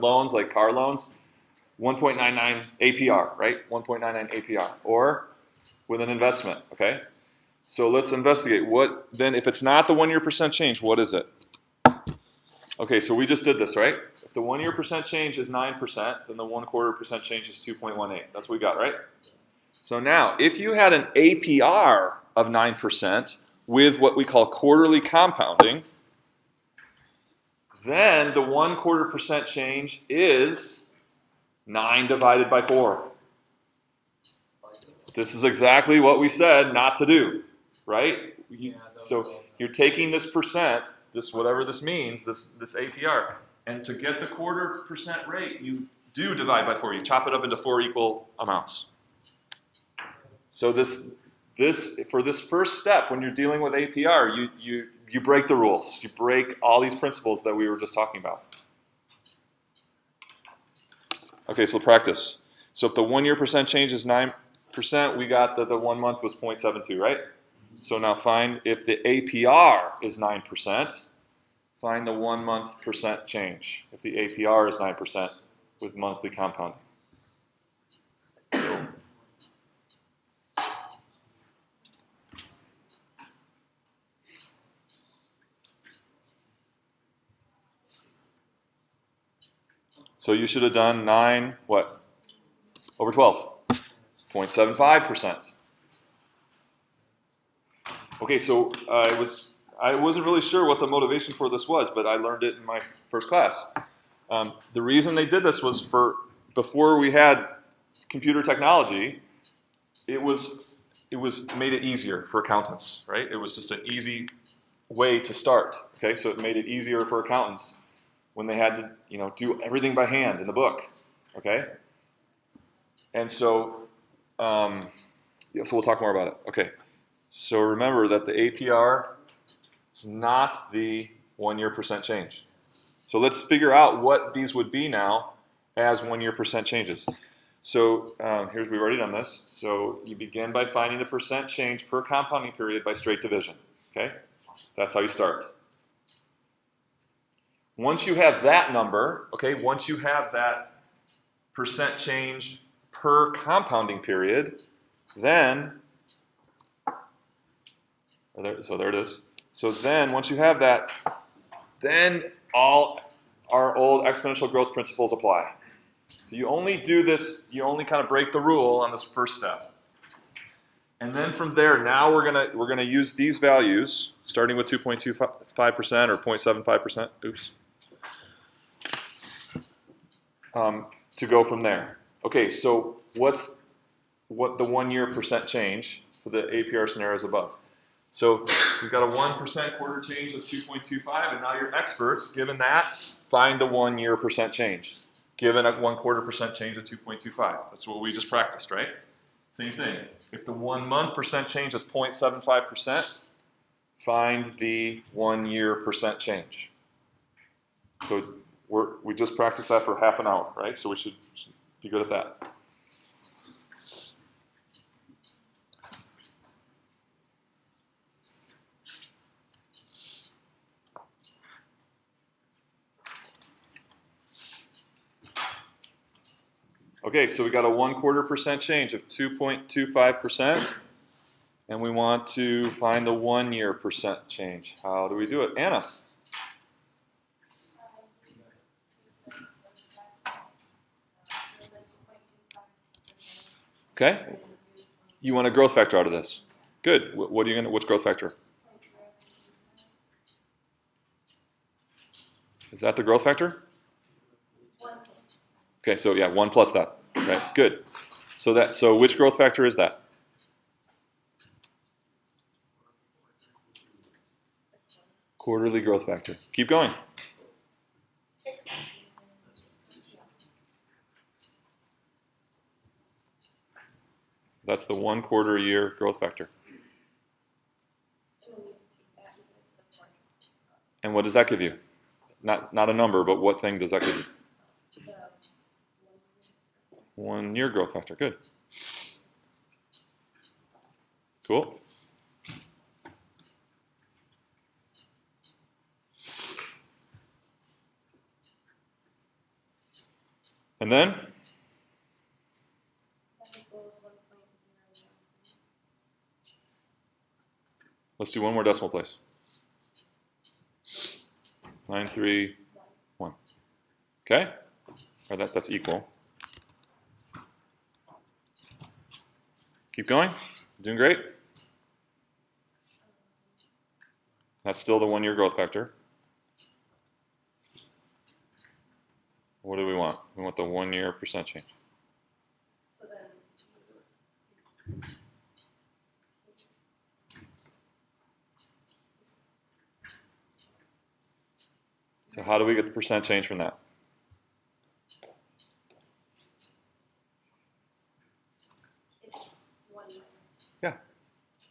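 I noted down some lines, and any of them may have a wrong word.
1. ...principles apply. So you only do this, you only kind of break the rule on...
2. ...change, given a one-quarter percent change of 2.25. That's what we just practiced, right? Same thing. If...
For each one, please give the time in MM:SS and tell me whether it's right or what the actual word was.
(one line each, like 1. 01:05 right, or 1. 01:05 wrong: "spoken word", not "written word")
1. 02:44 right
2. 03:14 right.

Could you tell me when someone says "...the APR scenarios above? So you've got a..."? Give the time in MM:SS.
03:06.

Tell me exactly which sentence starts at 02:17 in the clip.
So um, here's, we've already done this.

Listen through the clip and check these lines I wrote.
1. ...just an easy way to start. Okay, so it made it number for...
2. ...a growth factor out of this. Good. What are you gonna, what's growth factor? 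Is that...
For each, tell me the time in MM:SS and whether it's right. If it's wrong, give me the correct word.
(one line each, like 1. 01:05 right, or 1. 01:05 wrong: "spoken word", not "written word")
1. 01:53 wrong: "easier", not "number"
2. 04:05 right.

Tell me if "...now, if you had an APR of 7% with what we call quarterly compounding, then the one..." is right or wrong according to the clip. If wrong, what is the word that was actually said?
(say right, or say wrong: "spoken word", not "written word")
wrong: "9", not "7".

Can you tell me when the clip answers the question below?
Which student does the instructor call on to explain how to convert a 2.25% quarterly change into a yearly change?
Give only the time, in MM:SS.
03:55.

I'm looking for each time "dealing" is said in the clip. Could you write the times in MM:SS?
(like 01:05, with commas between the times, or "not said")
00:53.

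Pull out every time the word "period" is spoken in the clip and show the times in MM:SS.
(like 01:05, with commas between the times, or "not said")
02:22, 02:33.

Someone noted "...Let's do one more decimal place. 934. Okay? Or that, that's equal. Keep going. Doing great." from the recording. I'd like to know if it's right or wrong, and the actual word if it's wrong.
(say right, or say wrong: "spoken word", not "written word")
wrong: "931", not "934".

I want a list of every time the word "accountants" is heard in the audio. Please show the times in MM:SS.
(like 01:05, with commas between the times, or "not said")
01:52, 01:57.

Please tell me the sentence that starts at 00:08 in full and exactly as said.
What then, if it's not the one year percent change, what is it?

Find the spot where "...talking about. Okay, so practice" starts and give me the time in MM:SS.
00:57.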